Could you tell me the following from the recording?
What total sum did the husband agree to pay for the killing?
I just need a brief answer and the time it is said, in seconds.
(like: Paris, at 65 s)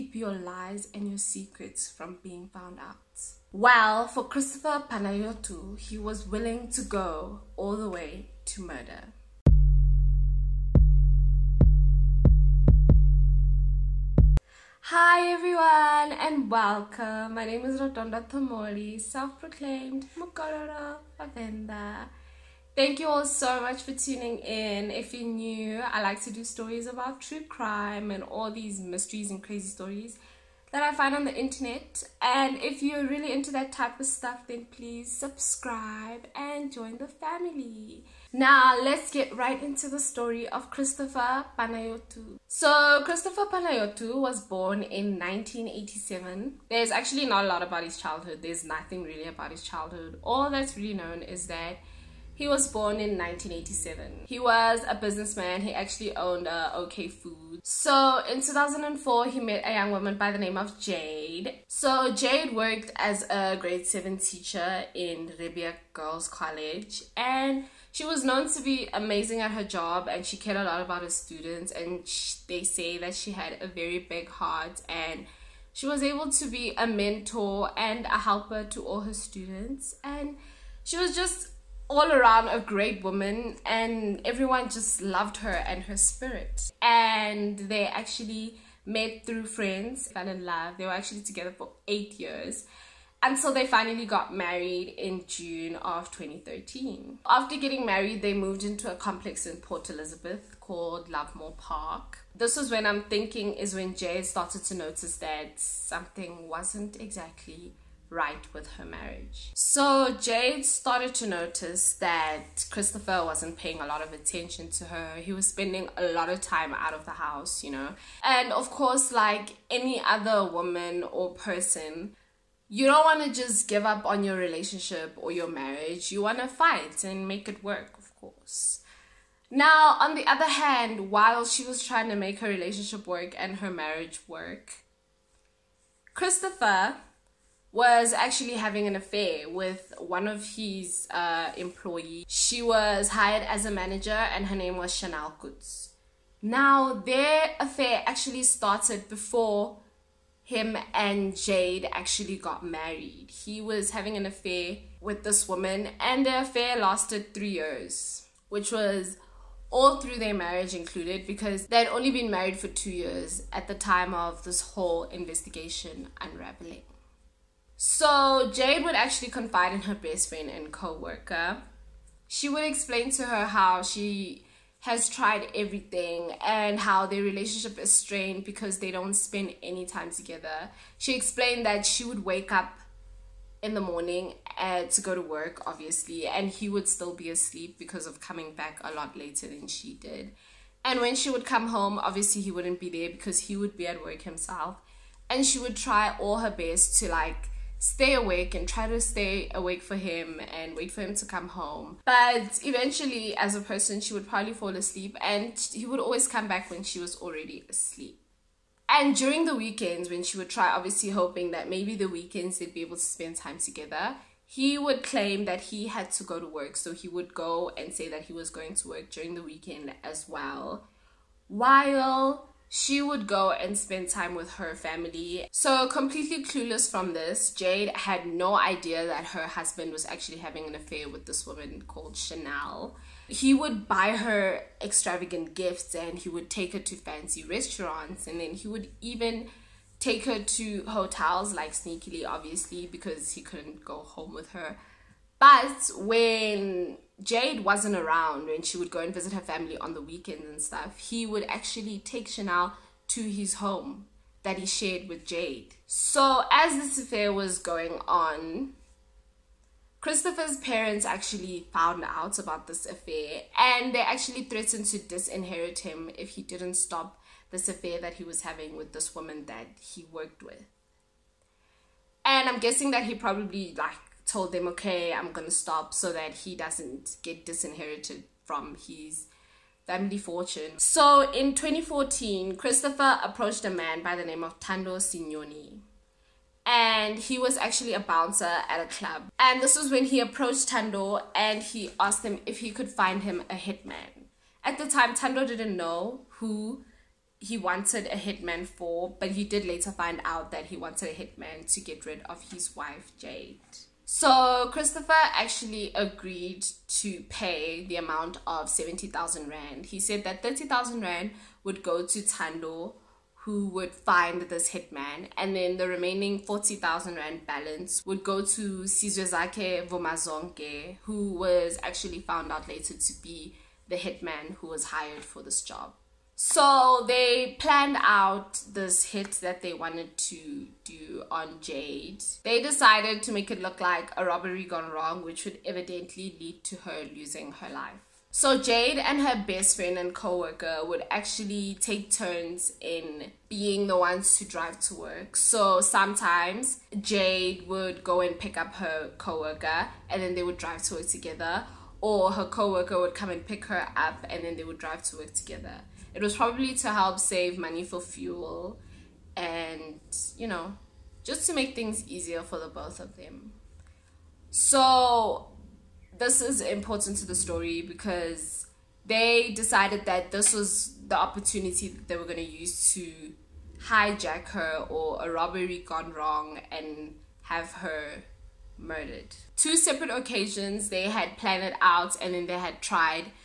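70,000 Rand, at 308 s.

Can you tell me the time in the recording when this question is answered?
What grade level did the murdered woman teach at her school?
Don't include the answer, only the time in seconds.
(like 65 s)
63 s.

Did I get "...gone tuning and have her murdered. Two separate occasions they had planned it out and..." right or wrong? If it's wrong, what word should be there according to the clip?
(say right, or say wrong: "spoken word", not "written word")
wrong: "wrong", not "tuning".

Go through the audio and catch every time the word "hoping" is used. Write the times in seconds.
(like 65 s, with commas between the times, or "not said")
211 s.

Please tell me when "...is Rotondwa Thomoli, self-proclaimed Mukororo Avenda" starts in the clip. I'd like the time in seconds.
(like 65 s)
17 s.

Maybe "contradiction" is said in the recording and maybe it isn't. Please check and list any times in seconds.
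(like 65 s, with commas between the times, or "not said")
not said.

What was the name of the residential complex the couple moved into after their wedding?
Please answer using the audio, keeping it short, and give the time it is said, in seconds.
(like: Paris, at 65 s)
Lovemore Park, at 101 s.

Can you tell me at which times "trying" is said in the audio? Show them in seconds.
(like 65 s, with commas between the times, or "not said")
131 s.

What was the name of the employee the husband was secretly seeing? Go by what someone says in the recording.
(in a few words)
Chanelle Coetzee.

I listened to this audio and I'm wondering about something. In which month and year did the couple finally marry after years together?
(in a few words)
June 2013.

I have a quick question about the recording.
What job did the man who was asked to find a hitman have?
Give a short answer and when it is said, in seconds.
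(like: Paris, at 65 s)
Bouncer, at 287 s.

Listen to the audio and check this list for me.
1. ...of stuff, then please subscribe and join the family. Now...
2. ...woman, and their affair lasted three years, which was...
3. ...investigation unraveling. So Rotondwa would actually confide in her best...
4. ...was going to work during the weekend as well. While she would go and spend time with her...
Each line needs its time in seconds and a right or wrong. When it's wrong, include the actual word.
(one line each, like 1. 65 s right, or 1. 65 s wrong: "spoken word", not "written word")
1. 33 s right
2. 155 s right
3. 165 s wrong: "Jade", not "Rotondwa"
4. 218 s right.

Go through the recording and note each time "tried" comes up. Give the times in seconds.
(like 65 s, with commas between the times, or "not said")
175 s, 382 s.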